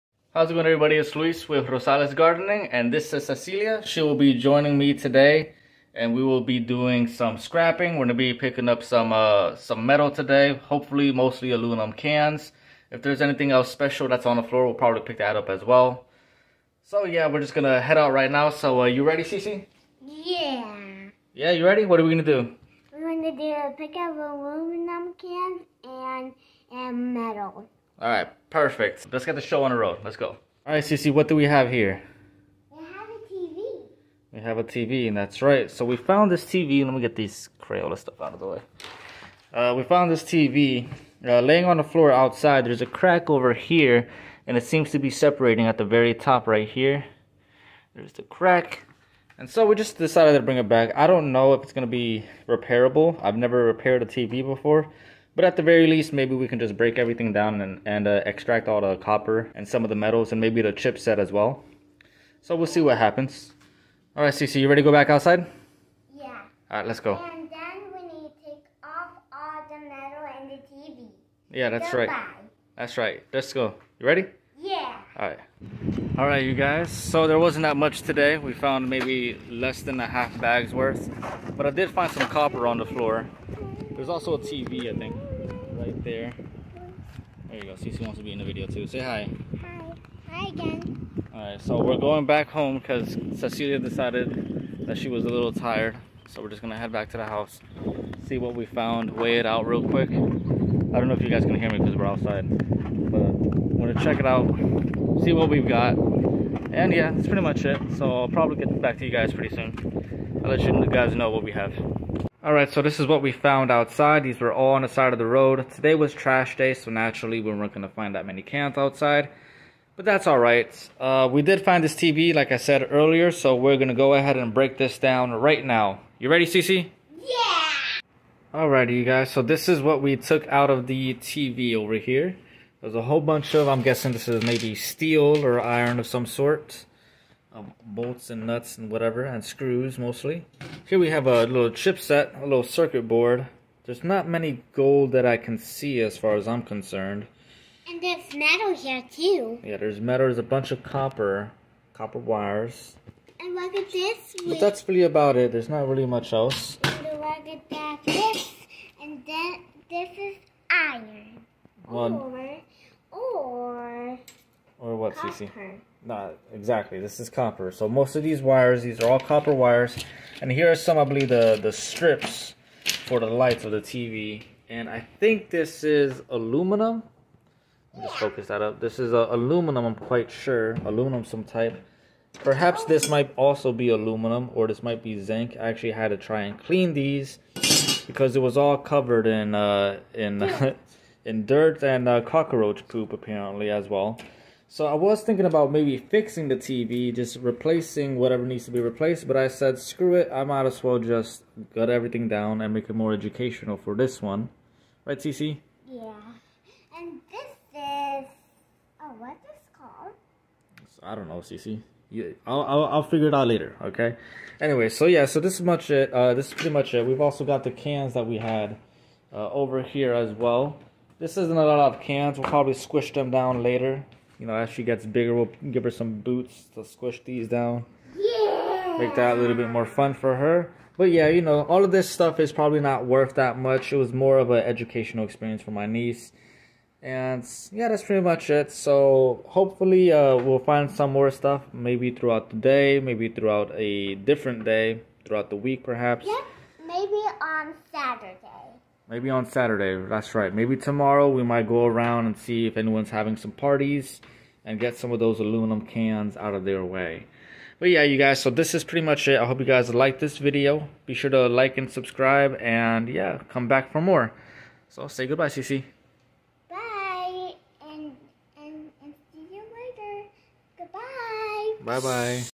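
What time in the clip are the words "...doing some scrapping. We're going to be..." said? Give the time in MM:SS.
00:06.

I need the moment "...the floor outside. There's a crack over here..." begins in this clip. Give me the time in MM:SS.
00:41.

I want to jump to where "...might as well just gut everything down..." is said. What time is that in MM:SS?
03:20.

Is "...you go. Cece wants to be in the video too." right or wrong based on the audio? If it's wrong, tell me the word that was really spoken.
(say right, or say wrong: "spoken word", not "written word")
right.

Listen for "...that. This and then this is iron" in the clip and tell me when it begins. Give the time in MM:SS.
02:37.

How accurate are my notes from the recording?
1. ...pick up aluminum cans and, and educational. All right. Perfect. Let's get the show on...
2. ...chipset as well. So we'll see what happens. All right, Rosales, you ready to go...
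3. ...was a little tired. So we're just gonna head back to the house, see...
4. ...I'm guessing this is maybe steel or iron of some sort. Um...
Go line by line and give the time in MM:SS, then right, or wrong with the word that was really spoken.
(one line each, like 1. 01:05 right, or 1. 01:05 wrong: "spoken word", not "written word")
1. 00:23 wrong: "metal", not "educational"
2. 01:00 wrong: "Cece", not "Rosales"
3. 01:35 right
4. 02:13 right.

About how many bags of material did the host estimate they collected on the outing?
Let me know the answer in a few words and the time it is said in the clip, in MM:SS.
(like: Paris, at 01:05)
less than a half bag, at 01:19.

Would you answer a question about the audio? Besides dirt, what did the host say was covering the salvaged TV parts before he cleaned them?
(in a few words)
cockroach poop.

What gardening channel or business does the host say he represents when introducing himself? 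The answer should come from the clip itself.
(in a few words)
Rosales Gardening.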